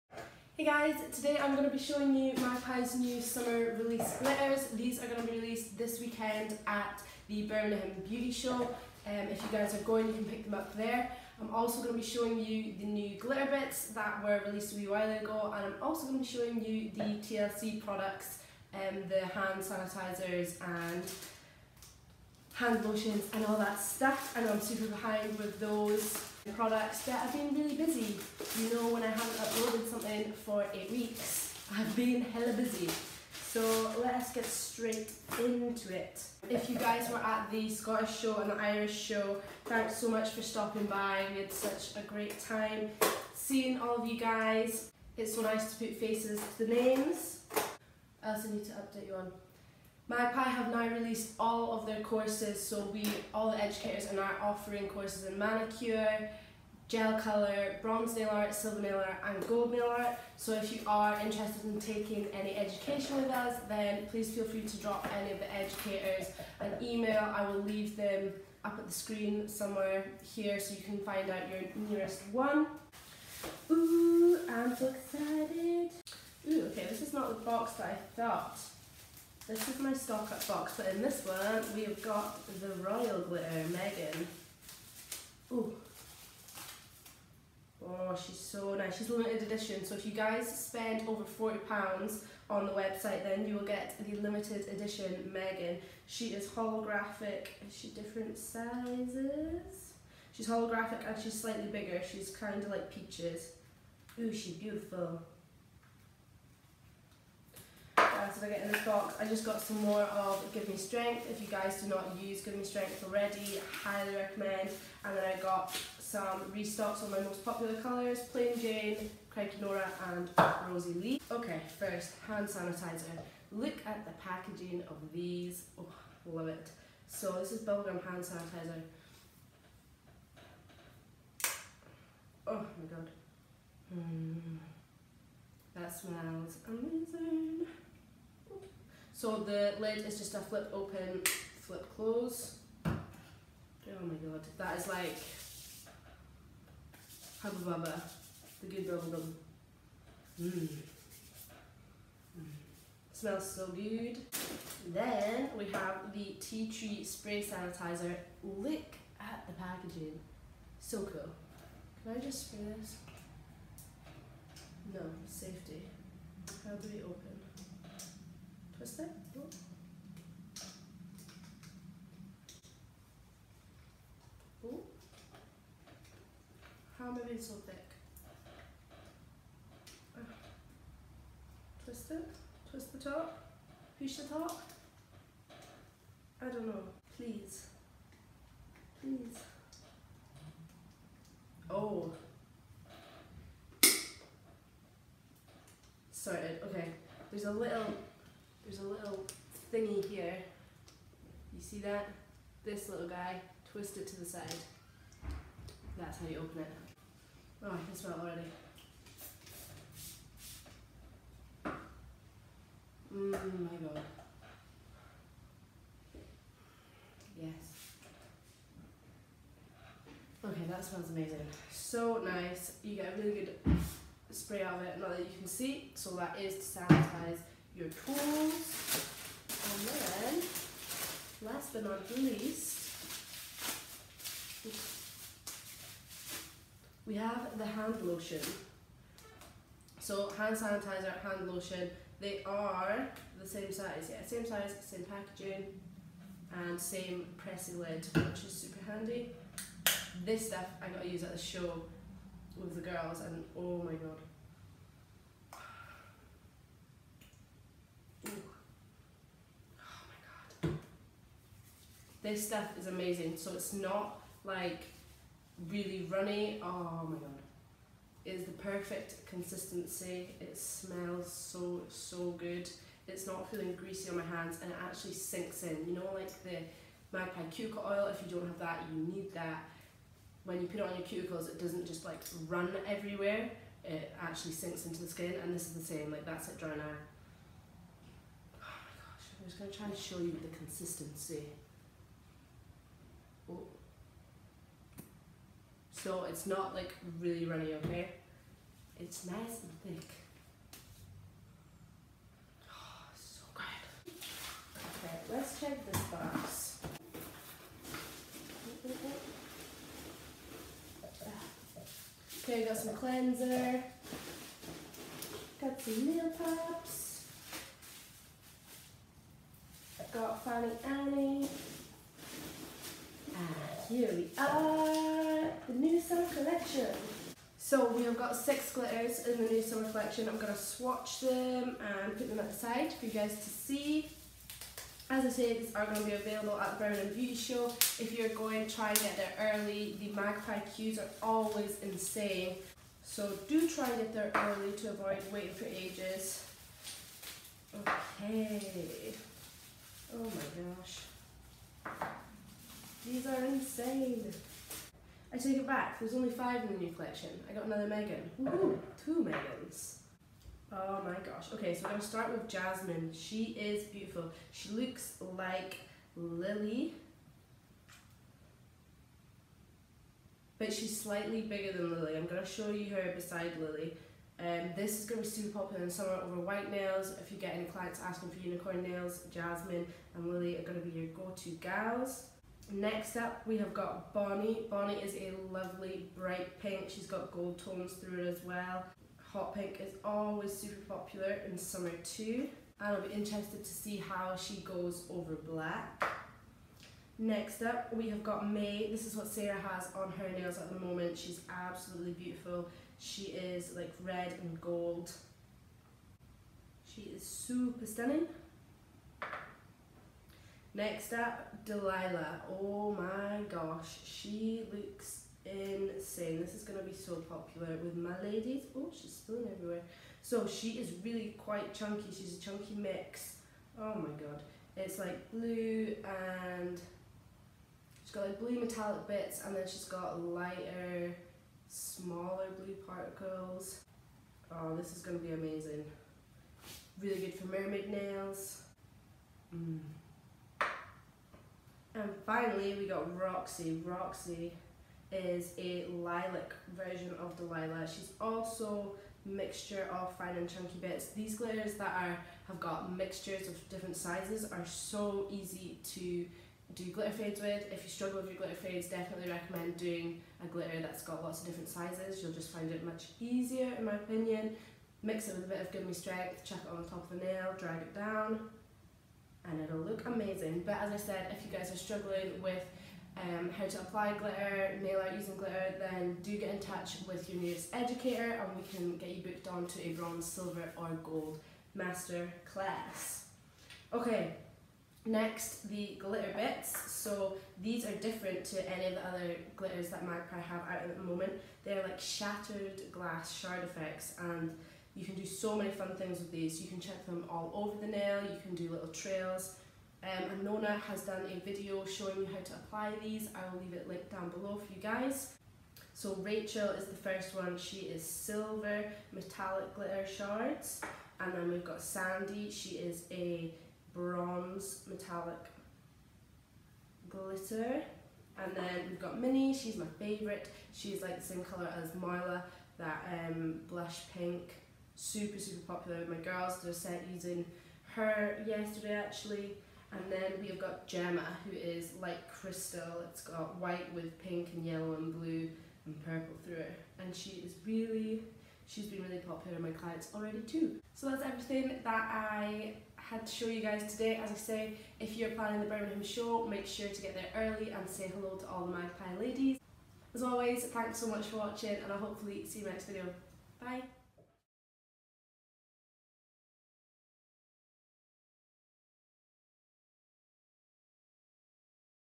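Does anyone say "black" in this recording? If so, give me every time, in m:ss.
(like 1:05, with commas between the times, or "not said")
6:35.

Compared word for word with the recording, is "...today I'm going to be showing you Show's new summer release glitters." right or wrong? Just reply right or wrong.
wrong.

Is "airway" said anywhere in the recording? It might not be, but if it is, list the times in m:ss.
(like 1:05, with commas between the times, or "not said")
not said.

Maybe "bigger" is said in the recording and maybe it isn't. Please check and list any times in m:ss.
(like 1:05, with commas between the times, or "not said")
1:41, 6:11.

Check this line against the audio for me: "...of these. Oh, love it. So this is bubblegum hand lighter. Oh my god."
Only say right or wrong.
wrong.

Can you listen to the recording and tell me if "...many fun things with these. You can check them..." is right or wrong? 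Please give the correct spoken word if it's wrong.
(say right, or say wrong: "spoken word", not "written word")
right.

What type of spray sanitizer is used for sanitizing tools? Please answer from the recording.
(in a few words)
Tea tree.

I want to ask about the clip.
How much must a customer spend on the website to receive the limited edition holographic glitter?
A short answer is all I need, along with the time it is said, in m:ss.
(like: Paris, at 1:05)
£40, at 1:31.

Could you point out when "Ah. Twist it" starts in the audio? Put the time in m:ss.
3:00.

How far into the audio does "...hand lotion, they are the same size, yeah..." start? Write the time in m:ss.
4:01.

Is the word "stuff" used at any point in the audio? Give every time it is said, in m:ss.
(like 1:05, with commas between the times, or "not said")
0:23, 4:10, 4:22.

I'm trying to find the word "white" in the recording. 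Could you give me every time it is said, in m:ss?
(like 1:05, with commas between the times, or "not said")
6:16, 8:53.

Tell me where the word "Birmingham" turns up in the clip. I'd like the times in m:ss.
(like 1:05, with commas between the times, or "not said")
0:07, 5:36, 9:05.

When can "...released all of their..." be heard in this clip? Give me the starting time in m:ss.
0:50.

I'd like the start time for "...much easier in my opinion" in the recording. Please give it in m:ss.
7:42.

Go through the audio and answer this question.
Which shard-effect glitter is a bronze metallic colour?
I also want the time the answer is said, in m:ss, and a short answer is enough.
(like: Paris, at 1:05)
Sandy, at 8:31.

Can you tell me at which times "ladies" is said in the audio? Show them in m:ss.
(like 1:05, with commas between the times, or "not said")
6:58, 9:09.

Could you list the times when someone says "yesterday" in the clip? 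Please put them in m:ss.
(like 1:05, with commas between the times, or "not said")
8:48.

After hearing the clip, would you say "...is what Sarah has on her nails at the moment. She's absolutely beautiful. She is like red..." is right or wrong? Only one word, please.
right.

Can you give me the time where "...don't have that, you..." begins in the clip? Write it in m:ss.
4:38.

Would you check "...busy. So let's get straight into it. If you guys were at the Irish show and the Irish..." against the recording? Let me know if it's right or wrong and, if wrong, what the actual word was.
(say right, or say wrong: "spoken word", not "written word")
wrong: "Scottish", not "Irish".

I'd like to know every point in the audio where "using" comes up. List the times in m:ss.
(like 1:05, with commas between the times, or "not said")
7:55, 8:47.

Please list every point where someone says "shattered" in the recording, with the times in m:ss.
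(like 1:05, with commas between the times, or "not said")
8:11.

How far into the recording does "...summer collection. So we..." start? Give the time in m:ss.
5:25.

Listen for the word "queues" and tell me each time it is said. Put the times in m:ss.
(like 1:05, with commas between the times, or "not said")
5:40.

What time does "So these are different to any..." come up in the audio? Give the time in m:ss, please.
8:06.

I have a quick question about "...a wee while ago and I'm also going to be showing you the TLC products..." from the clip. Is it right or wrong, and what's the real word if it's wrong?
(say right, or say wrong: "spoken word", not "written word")
right.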